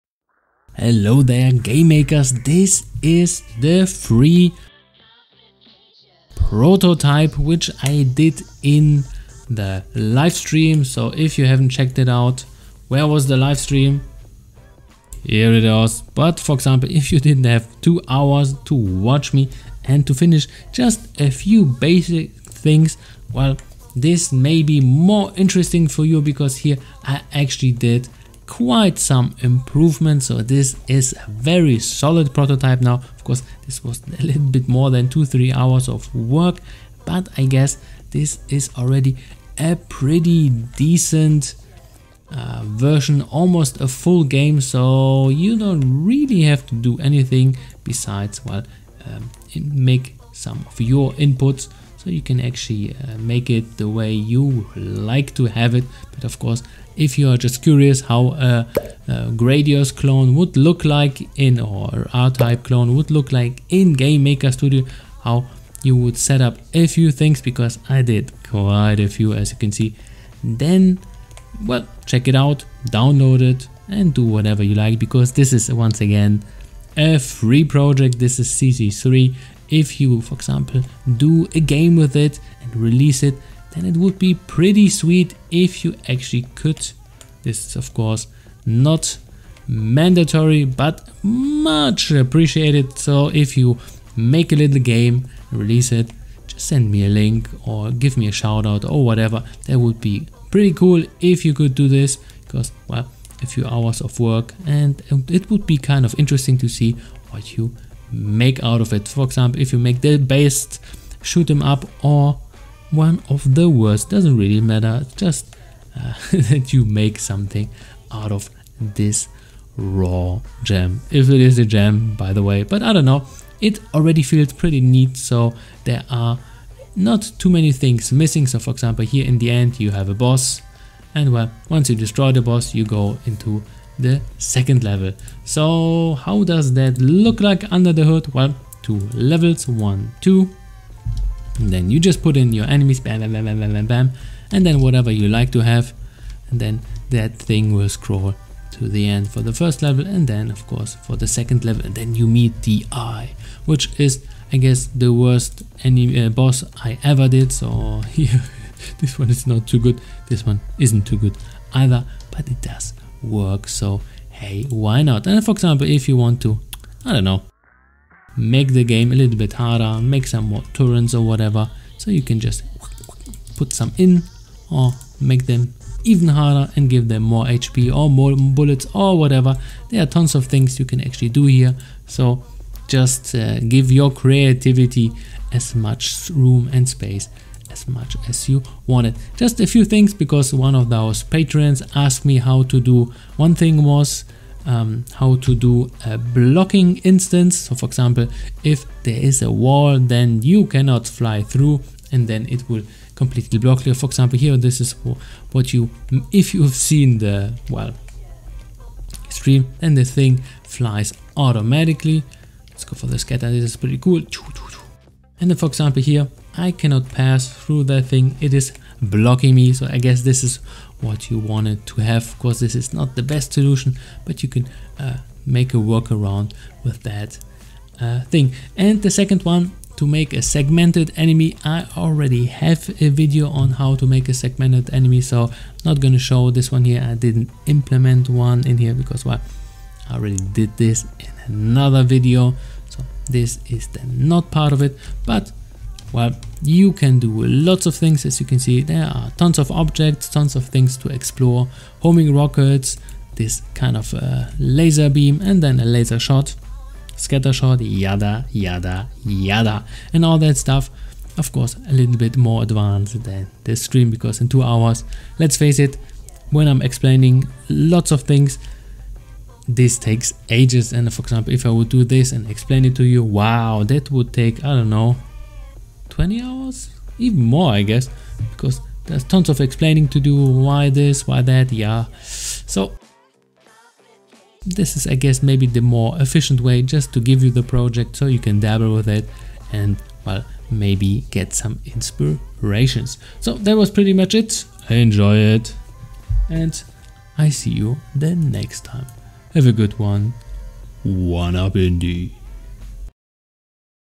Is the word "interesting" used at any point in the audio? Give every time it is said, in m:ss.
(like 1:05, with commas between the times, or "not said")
0:25, 1:46.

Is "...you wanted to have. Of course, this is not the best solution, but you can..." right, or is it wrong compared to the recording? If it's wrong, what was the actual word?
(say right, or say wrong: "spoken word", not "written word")
right.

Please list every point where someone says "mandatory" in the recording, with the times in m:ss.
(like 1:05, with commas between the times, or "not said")
1:29.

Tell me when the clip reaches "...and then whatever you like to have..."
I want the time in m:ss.
2:24.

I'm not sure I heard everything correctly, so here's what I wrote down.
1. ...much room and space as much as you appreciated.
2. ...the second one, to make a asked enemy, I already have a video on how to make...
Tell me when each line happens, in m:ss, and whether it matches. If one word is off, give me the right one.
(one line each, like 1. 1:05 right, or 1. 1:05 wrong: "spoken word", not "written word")
1. 3:05 wrong: "wanted", not "appreciated"
2. 3:49 wrong: "segmented", not "asked".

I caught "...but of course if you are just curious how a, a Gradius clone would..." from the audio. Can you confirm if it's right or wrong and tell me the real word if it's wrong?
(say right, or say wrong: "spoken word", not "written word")
right.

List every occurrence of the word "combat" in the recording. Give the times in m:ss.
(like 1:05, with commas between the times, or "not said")
not said.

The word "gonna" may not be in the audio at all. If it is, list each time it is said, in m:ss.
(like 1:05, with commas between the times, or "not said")
3:55.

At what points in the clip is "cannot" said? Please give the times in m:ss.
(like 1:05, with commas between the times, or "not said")
3:20, 3:36.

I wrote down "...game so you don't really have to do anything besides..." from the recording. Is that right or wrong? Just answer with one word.
right.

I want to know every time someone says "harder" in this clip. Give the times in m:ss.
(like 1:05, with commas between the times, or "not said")
2:49, 2:56.